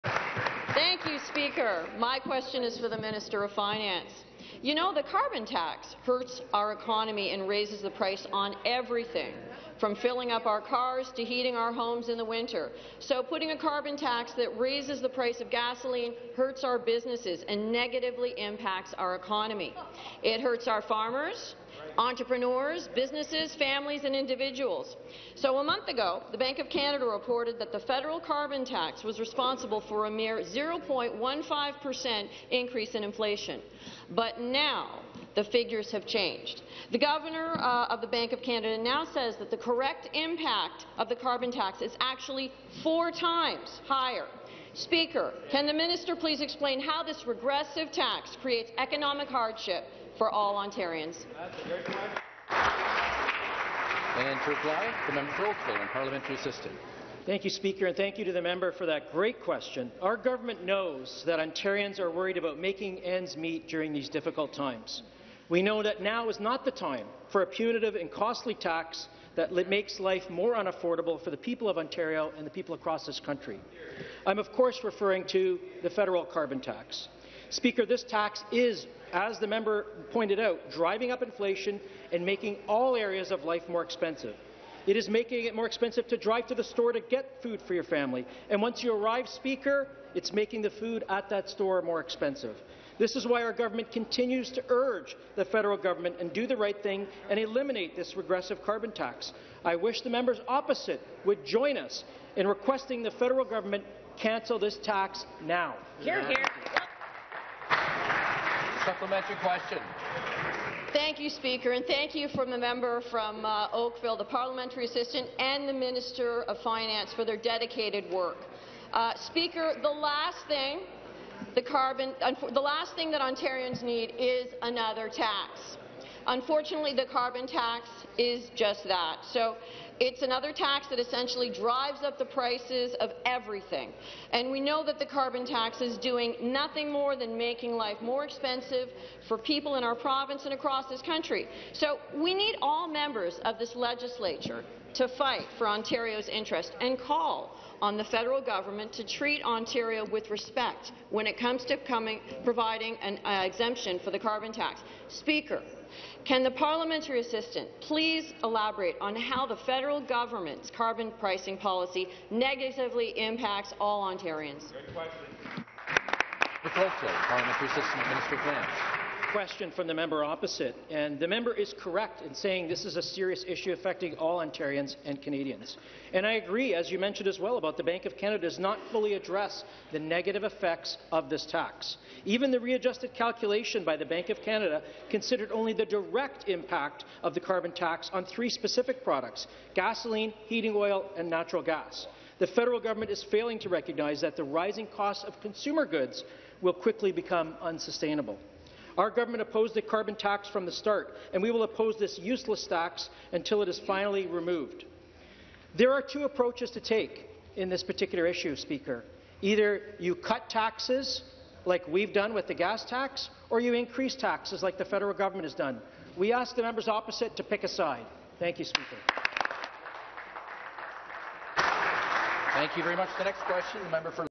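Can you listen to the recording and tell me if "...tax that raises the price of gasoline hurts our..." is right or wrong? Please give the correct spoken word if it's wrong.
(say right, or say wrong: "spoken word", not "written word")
right.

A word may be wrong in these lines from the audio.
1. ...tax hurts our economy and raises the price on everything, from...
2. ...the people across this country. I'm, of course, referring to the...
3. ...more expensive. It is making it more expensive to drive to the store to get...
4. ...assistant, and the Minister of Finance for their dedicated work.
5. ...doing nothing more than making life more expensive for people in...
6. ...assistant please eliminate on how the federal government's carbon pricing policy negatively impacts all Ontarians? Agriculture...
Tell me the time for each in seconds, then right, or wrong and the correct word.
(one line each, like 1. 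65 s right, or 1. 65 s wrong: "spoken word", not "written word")
1. 5 s right
2. 72 s right
3. 83 s right
4. 114 s right
5. 135 s right
6. 157 s wrong: "elaborate", not "eliminate".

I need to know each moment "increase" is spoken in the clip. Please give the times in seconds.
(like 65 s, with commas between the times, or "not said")
32 s, 213 s.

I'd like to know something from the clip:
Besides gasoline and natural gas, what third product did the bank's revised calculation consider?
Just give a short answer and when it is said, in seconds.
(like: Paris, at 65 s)
heating oil, at 190 s.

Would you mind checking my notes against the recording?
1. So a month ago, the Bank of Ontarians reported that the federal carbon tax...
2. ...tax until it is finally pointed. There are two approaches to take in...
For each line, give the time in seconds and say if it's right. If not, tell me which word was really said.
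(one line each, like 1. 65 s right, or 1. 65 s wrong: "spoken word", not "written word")
1. 25 s wrong: "Canada", not "Ontarians"
2. 202 s wrong: "removed", not "pointed".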